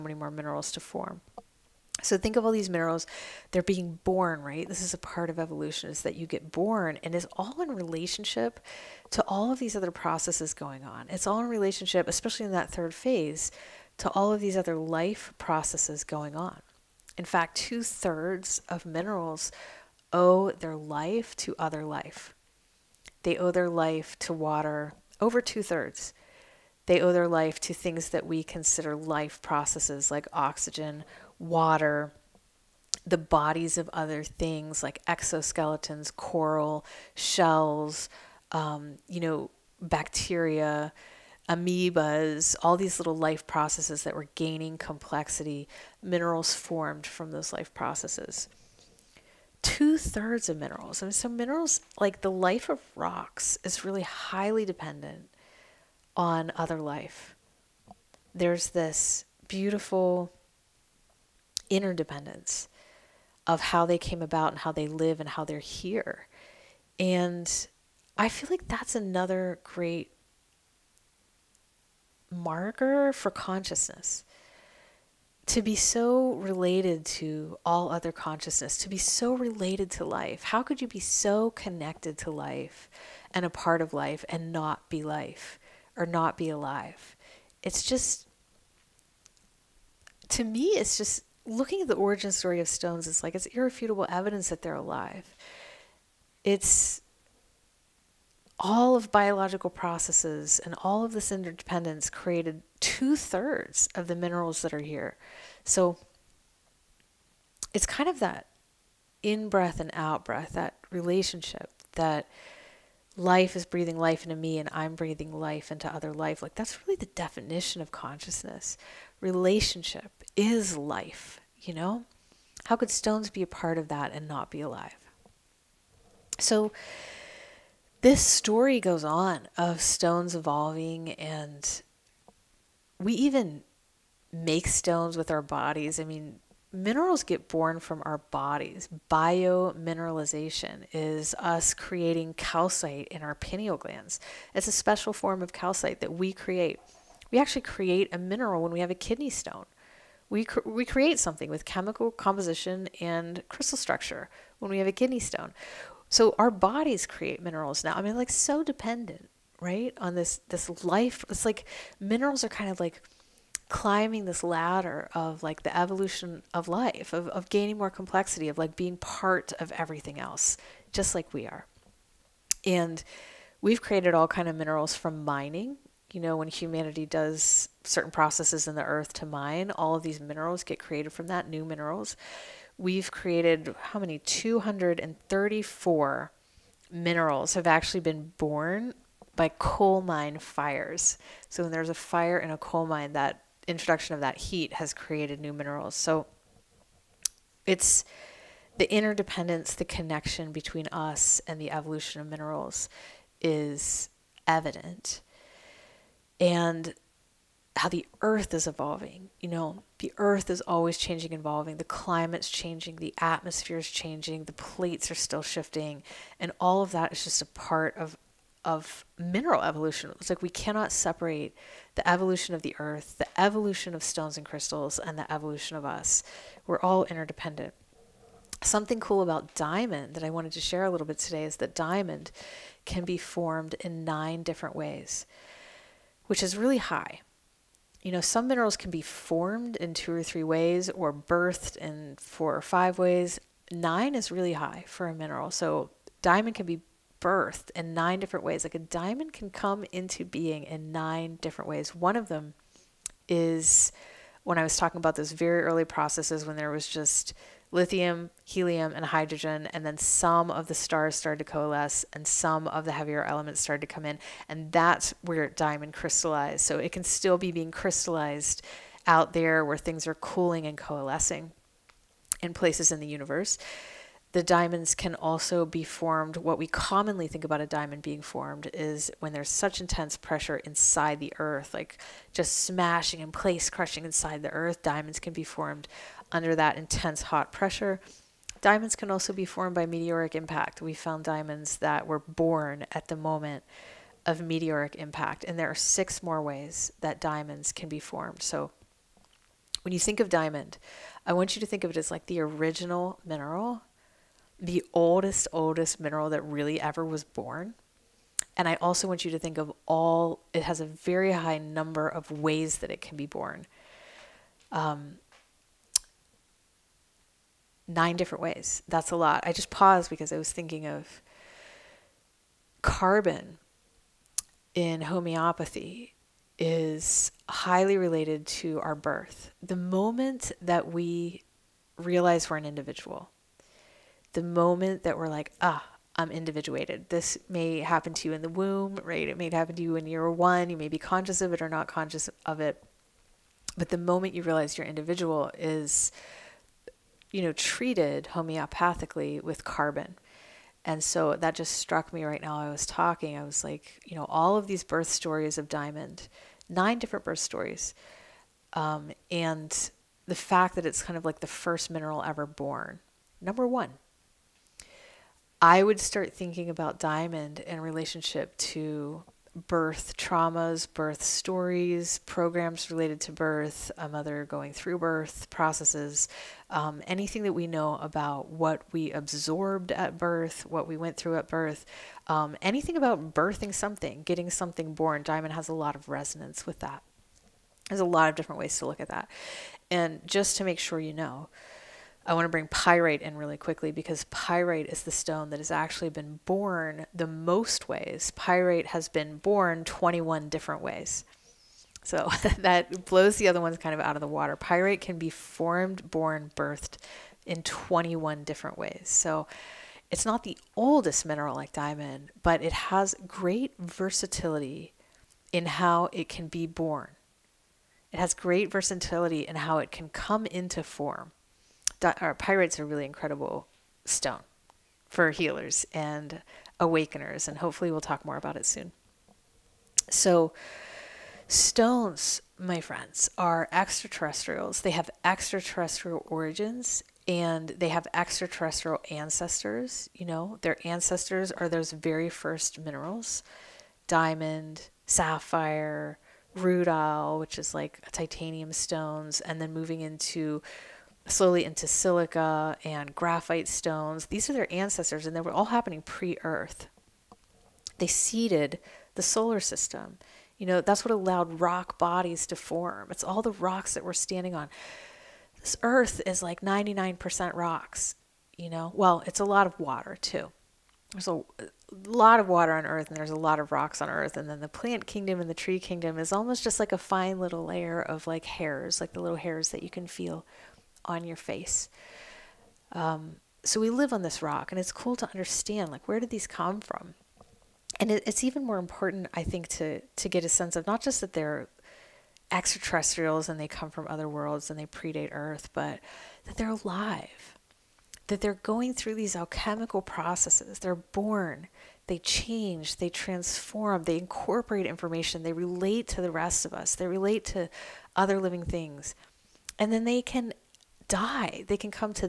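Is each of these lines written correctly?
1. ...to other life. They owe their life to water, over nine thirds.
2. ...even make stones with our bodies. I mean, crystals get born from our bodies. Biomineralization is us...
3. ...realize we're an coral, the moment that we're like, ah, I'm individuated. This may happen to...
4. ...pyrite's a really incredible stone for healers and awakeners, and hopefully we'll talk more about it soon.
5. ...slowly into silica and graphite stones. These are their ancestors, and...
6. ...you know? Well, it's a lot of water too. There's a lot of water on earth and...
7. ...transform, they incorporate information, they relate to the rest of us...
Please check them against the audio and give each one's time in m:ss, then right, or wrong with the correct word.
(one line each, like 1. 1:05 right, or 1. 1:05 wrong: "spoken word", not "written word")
1. 0:21 wrong: "two", not "nine"
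2. 2:13 wrong: "minerals", not "crystals"
3. 5:31 wrong: "individual", not "coral"
4. 7:02 right
5. 7:31 right
6. 7:48 right
7. 8:23 right.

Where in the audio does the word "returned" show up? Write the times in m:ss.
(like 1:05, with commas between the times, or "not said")
not said.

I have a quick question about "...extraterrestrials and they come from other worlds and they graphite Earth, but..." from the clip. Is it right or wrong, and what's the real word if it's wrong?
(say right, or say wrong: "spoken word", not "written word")
wrong: "predate", not "graphite".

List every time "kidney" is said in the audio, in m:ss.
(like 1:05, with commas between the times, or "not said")
2:28, 2:34.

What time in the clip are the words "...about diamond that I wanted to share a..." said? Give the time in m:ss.
3:49.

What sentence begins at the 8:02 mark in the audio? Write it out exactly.
Um, so we live on this rock, and it's cool to understand like where did these come from.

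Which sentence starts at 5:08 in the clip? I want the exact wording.
And I also want you to think of all, it has a very high number of ways that it can be born.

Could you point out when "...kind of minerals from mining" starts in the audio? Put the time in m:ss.
2:54.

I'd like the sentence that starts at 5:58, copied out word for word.
Um, and the fact that it's kind of like the first mineral ever born.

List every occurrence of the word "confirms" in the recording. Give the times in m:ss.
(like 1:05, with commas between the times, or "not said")
not said.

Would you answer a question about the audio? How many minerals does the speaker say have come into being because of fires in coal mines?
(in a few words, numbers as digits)
234.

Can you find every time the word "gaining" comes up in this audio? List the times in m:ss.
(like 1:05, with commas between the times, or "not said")
0:44, 2:47.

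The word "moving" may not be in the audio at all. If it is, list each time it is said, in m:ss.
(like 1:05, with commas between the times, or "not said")
7:29.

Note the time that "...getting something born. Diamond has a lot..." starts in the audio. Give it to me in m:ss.
6:24.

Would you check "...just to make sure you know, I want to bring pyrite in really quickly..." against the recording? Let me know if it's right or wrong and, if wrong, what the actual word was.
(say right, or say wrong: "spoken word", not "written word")
right.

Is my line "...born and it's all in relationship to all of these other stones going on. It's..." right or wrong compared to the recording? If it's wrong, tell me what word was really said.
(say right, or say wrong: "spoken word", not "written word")
wrong: "processes", not "stones".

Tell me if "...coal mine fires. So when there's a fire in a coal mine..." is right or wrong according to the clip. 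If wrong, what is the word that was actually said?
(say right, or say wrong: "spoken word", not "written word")
right.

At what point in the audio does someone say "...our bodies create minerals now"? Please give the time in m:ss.
2:36.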